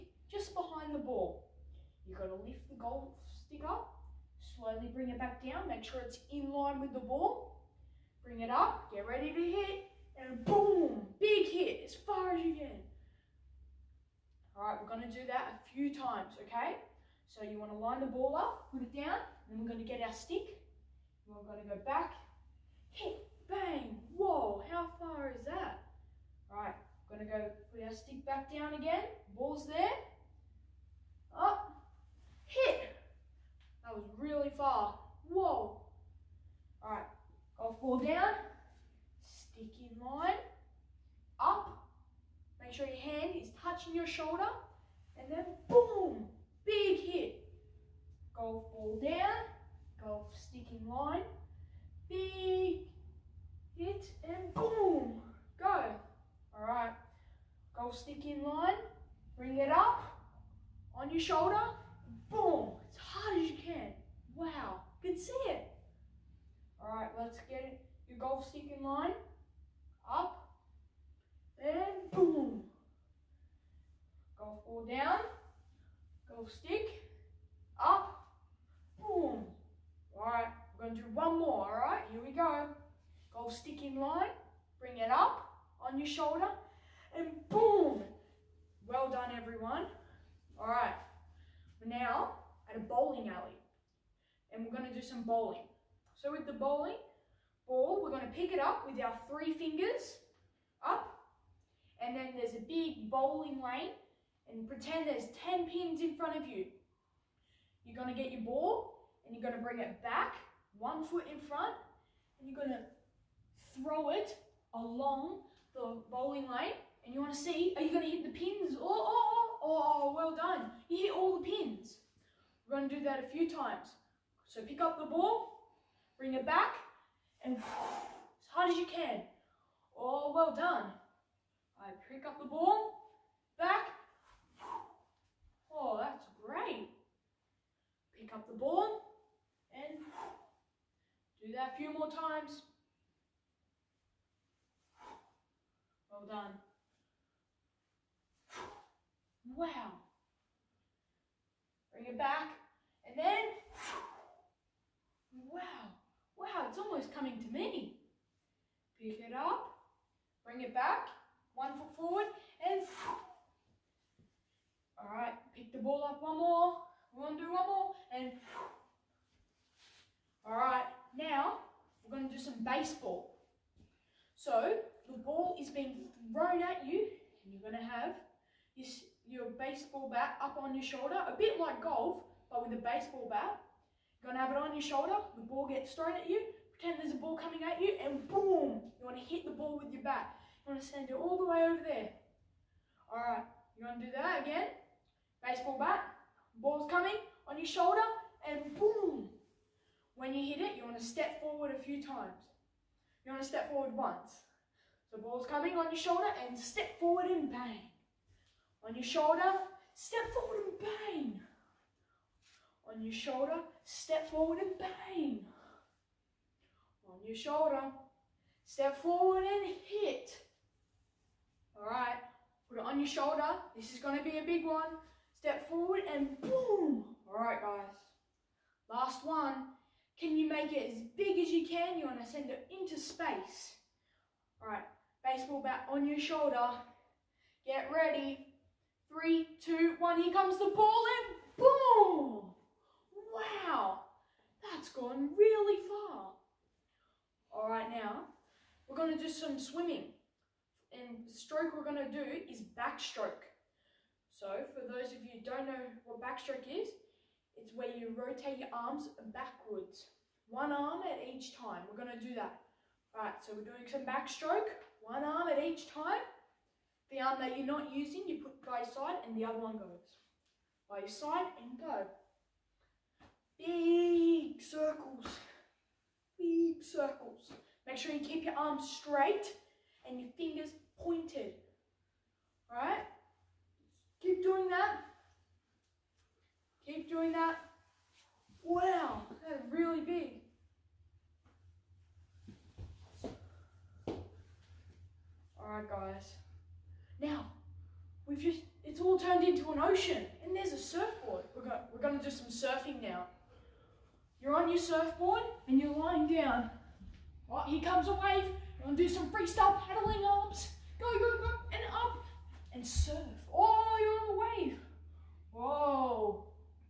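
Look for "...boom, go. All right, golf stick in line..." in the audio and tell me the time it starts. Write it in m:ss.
0:54.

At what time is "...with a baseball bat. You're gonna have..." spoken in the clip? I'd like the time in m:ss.
3:02.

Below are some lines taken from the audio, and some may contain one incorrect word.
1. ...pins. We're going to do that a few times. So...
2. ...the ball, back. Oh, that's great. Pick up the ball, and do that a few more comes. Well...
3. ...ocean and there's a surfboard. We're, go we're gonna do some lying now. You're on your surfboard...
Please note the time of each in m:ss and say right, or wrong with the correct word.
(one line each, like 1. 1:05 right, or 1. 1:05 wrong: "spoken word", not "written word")
1. 2:01 right
2. 2:12 wrong: "times", not "comes"
3. 4:59 wrong: "surfing", not "lying".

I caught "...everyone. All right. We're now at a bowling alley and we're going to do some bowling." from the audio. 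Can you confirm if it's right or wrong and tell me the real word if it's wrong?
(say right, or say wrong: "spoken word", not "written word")
right.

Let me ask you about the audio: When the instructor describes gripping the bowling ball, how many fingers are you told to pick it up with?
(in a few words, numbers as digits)
3.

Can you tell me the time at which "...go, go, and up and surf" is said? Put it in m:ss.
5:11.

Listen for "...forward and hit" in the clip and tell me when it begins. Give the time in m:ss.
3:39.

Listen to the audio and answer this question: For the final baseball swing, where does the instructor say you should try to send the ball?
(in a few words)
Into space.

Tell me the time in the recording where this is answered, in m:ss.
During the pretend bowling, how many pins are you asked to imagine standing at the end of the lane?
1:45.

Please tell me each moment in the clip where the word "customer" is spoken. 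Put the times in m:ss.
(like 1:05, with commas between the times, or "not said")
not said.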